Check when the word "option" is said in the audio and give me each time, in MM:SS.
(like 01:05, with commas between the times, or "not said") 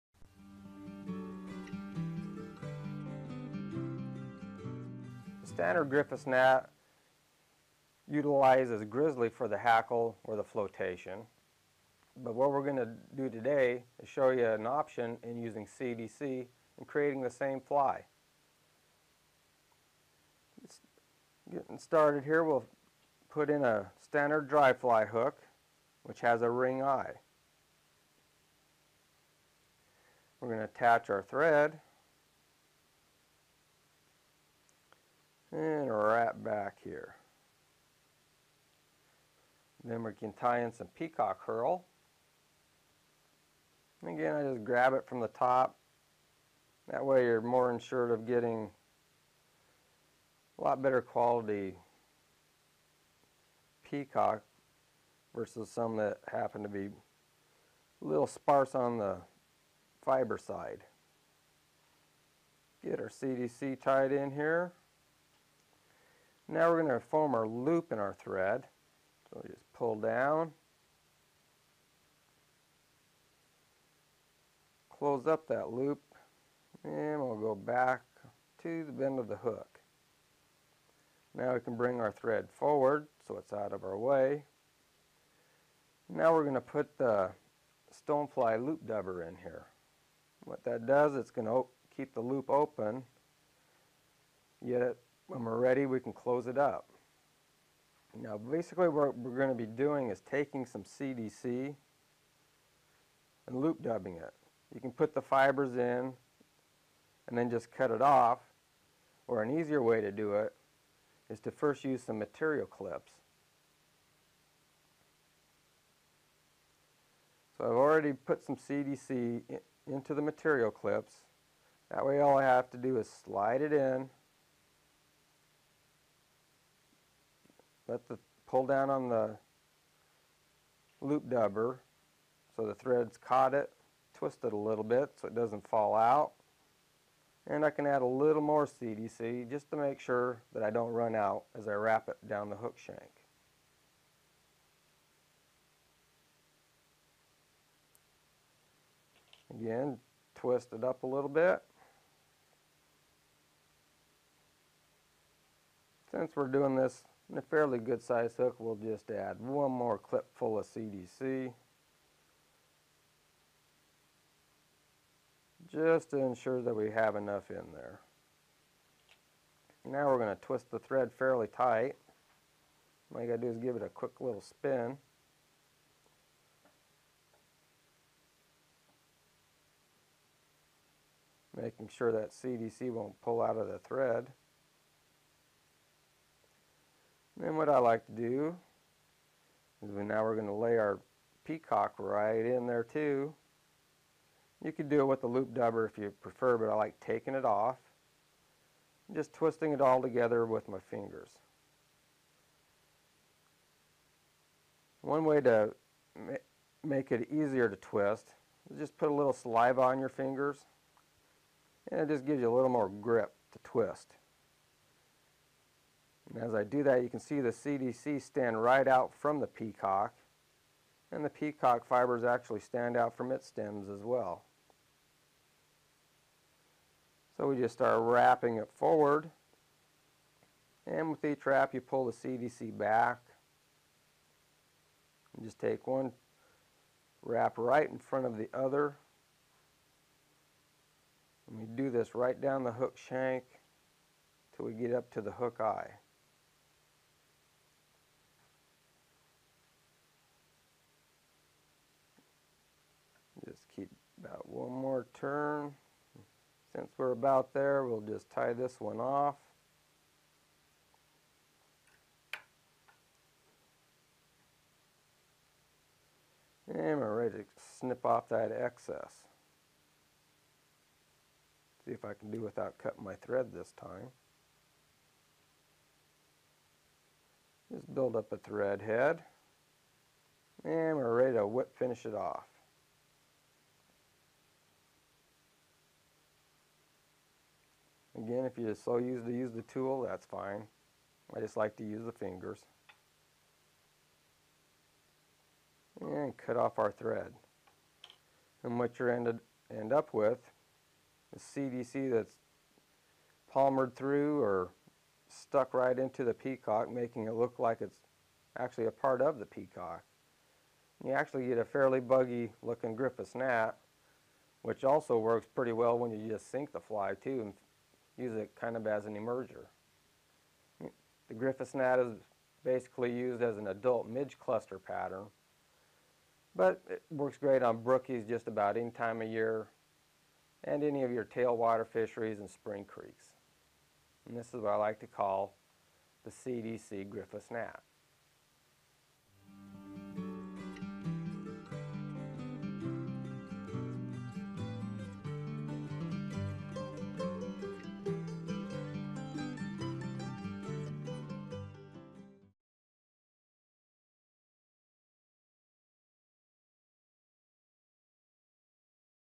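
00:14.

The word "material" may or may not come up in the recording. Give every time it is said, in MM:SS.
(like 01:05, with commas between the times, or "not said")
01:52, 02:00.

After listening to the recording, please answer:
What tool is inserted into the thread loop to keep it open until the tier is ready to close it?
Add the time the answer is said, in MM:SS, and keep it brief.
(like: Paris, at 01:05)
stonefly loop dubber, at 01:27.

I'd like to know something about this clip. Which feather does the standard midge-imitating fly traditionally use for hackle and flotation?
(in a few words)
grizzly.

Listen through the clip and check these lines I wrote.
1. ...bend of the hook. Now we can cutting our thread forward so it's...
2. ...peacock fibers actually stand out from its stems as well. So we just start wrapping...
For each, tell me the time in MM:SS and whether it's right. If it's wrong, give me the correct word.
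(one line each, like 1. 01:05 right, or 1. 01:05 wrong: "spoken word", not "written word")
1. 01:18 wrong: "bring", not "cutting"
2. 03:41 right.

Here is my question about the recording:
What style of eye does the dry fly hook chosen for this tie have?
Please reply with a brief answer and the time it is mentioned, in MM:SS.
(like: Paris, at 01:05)
ring eye, at 00:26.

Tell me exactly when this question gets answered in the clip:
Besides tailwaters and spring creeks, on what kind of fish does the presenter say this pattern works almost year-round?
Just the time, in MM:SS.
05:27.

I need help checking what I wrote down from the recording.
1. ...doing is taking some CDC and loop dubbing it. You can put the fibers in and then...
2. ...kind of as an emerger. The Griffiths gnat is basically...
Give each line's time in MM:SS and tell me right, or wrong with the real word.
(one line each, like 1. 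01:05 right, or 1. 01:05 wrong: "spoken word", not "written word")
1. 01:39 right
2. 05:18 right.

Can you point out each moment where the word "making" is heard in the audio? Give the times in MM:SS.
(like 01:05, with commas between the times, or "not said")
03:01, 05:06.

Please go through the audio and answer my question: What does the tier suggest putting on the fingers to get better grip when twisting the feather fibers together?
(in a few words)
saliva.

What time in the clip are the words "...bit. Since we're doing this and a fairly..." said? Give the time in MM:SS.
02:31.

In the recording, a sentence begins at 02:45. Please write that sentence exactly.
Just to ensure that we have enough in there.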